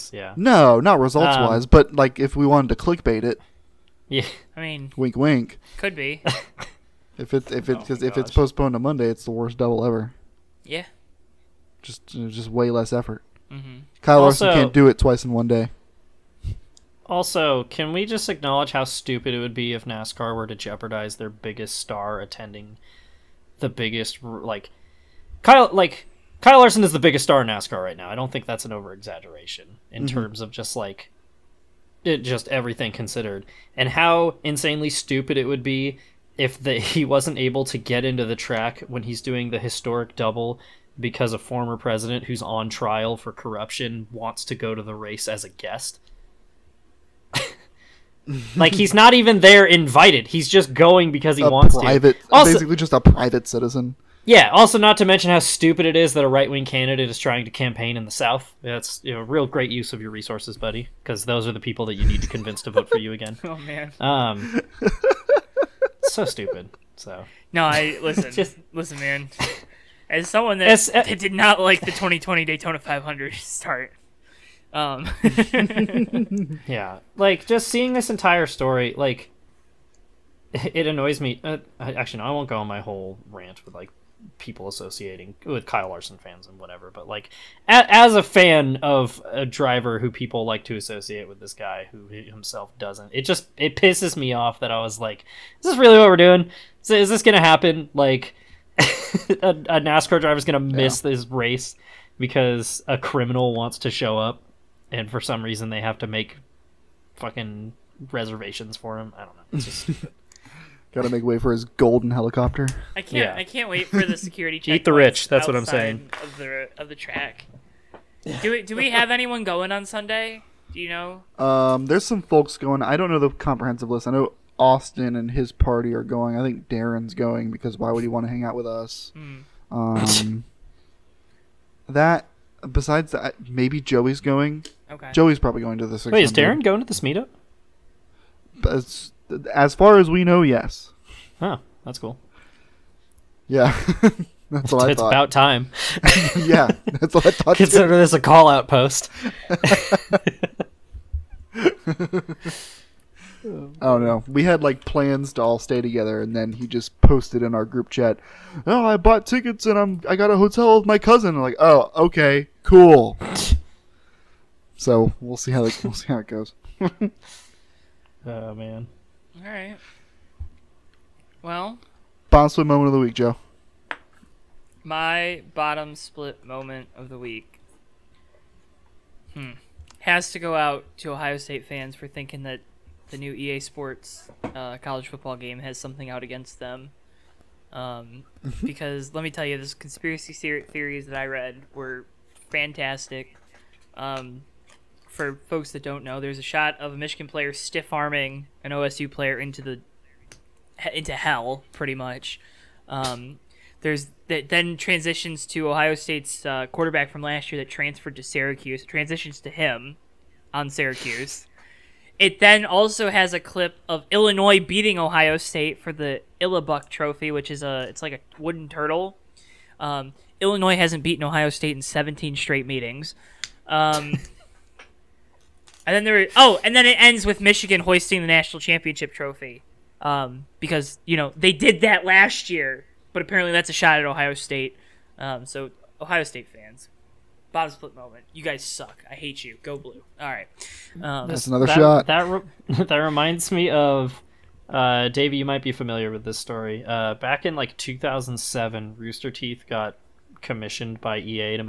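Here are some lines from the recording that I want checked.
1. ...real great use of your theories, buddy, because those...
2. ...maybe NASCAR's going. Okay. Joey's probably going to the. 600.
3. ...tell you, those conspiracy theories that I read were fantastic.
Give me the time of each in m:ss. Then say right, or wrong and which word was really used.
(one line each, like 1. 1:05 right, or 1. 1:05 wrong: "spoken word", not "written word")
1. 0:59 wrong: "resources", not "theories"
2. 2:13 wrong: "Joey", not "NASCAR"
3. 3:09 right.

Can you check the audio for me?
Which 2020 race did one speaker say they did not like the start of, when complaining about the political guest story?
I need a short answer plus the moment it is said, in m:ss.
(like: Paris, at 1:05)
Daytona 500, at 1:11.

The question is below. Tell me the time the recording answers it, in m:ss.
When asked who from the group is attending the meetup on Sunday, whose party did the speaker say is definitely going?
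2:04.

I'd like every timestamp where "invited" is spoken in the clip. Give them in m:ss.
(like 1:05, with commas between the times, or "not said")
0:49.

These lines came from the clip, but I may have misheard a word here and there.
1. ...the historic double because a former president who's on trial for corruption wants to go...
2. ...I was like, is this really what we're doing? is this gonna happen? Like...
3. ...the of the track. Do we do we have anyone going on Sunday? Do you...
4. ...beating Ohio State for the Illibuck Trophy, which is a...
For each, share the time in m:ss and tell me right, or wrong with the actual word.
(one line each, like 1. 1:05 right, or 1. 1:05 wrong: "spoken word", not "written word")
1. 0:39 right
2. 1:34 right
3. 1:56 right
4. 3:34 right.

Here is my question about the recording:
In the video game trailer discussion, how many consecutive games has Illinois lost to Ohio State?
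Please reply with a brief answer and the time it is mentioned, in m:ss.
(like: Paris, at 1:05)
17, at 3:41.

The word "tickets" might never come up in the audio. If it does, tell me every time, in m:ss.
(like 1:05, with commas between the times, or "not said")
2:39.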